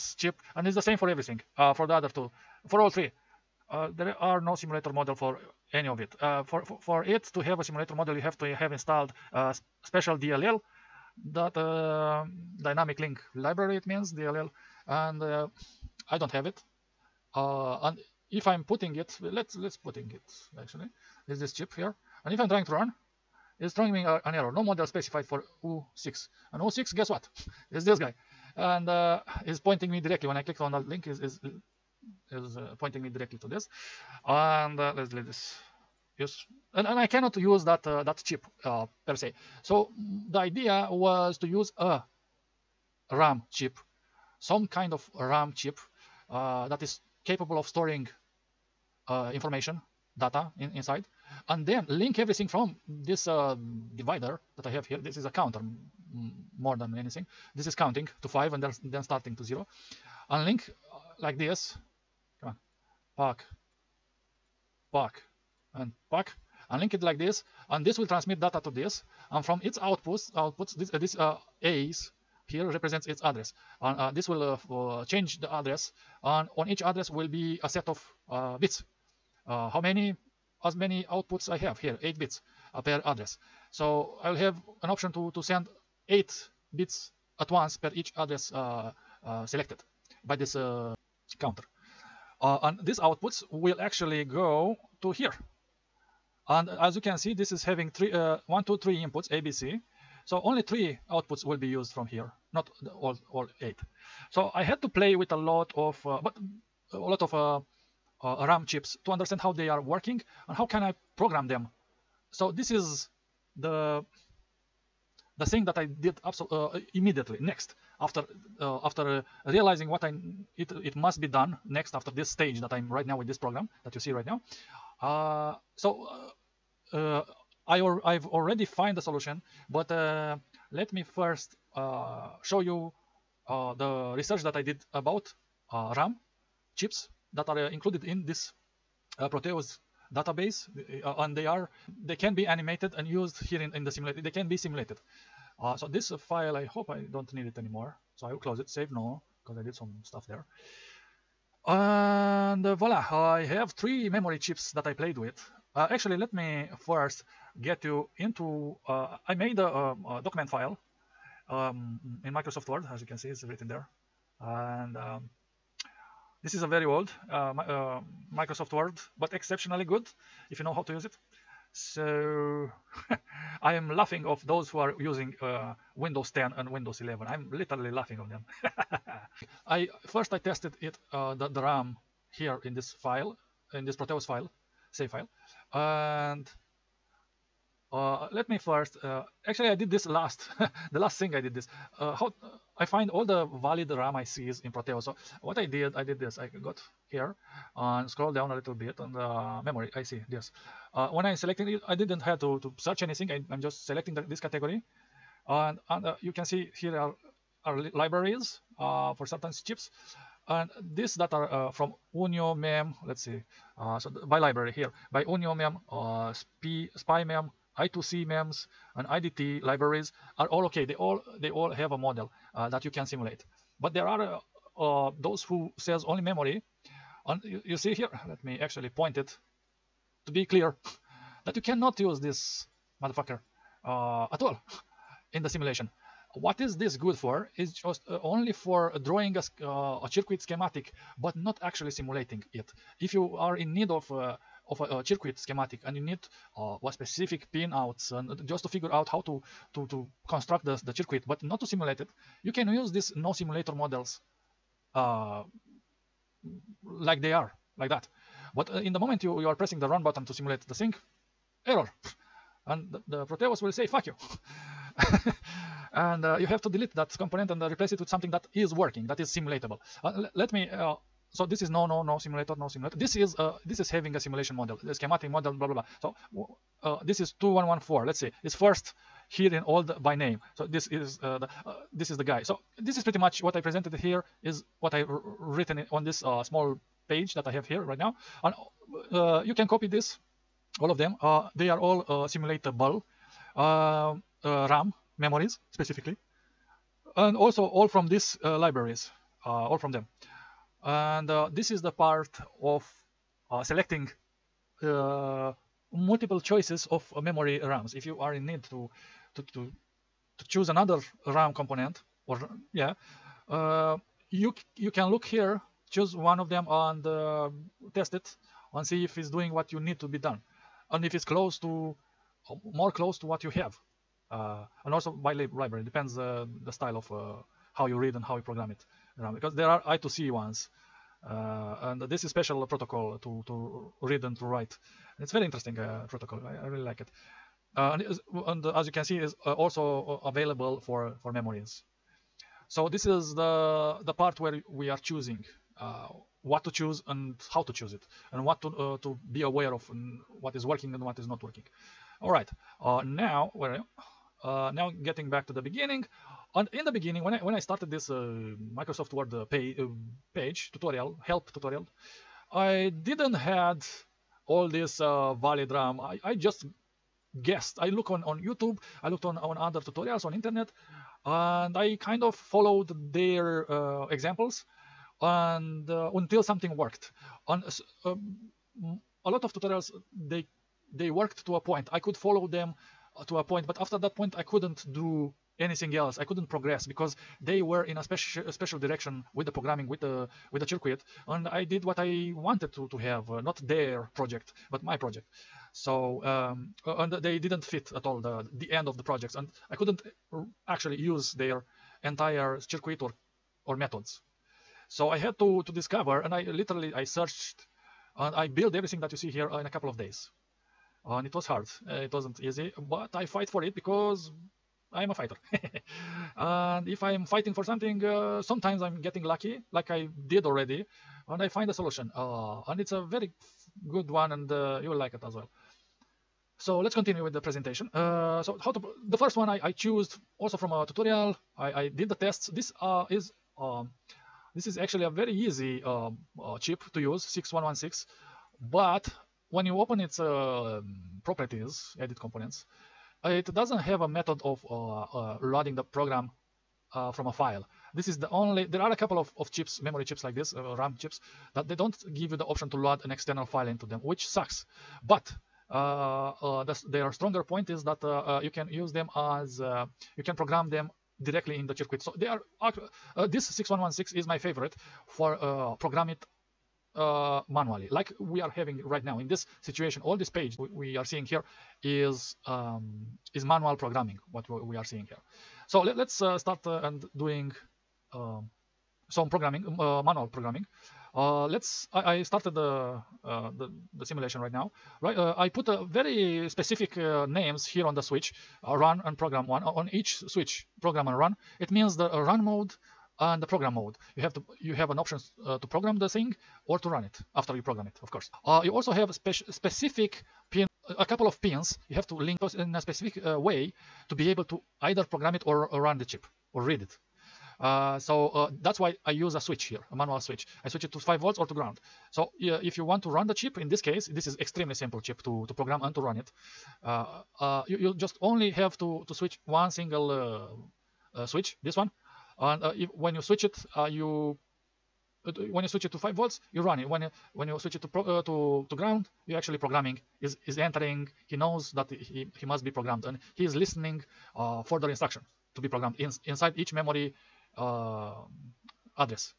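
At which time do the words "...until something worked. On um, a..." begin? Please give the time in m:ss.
6:16.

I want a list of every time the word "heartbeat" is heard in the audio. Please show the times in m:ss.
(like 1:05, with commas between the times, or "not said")
not said.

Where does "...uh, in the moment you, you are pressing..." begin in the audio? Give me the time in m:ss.
4:18.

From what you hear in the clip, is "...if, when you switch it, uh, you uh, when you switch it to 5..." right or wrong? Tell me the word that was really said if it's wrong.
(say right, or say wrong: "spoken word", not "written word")
right.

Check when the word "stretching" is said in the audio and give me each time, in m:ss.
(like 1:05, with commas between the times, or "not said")
not said.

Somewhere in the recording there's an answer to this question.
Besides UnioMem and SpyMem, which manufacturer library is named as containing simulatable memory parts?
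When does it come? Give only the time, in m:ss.
3:39.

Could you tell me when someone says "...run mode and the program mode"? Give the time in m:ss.
8:12.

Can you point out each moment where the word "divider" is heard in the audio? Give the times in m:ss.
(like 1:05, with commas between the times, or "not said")
0:53.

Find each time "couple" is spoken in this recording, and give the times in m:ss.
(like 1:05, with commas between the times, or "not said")
6:49, 7:28, 8:21.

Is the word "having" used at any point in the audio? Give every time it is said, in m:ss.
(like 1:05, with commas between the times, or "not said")
1:37, 4:33, 7:48.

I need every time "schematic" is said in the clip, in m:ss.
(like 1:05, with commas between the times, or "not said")
4:00, 4:05, 4:34.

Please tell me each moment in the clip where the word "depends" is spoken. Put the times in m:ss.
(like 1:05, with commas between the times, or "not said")
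5:25.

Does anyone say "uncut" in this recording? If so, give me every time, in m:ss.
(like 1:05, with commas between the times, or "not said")
not said.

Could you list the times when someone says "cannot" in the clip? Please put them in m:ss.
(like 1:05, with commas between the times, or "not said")
0:37, 3:51.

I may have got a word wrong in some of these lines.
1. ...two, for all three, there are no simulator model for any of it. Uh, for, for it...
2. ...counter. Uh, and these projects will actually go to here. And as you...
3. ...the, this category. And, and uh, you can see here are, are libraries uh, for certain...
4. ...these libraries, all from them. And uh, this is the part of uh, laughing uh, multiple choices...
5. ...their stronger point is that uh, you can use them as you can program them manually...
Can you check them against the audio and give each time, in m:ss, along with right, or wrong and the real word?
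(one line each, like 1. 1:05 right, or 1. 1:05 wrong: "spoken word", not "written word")
1. 0:02 right
2. 1:31 wrong: "outputs", not "projects"
3. 3:24 right
4. 4:58 wrong: "selecting", not "laughing"
5. 7:36 wrong: "directly", not "manually".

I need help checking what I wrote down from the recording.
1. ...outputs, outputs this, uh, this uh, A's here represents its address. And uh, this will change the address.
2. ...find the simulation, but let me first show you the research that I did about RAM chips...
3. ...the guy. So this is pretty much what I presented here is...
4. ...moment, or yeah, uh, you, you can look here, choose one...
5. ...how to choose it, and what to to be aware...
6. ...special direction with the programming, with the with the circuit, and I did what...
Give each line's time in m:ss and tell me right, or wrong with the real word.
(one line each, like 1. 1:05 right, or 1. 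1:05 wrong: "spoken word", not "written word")
1. 1:09 right
2. 2:08 wrong: "solution", not "simulation"
3. 4:42 right
4. 5:11 wrong: "component", not "moment"
5. 5:47 right
6. 6:28 right.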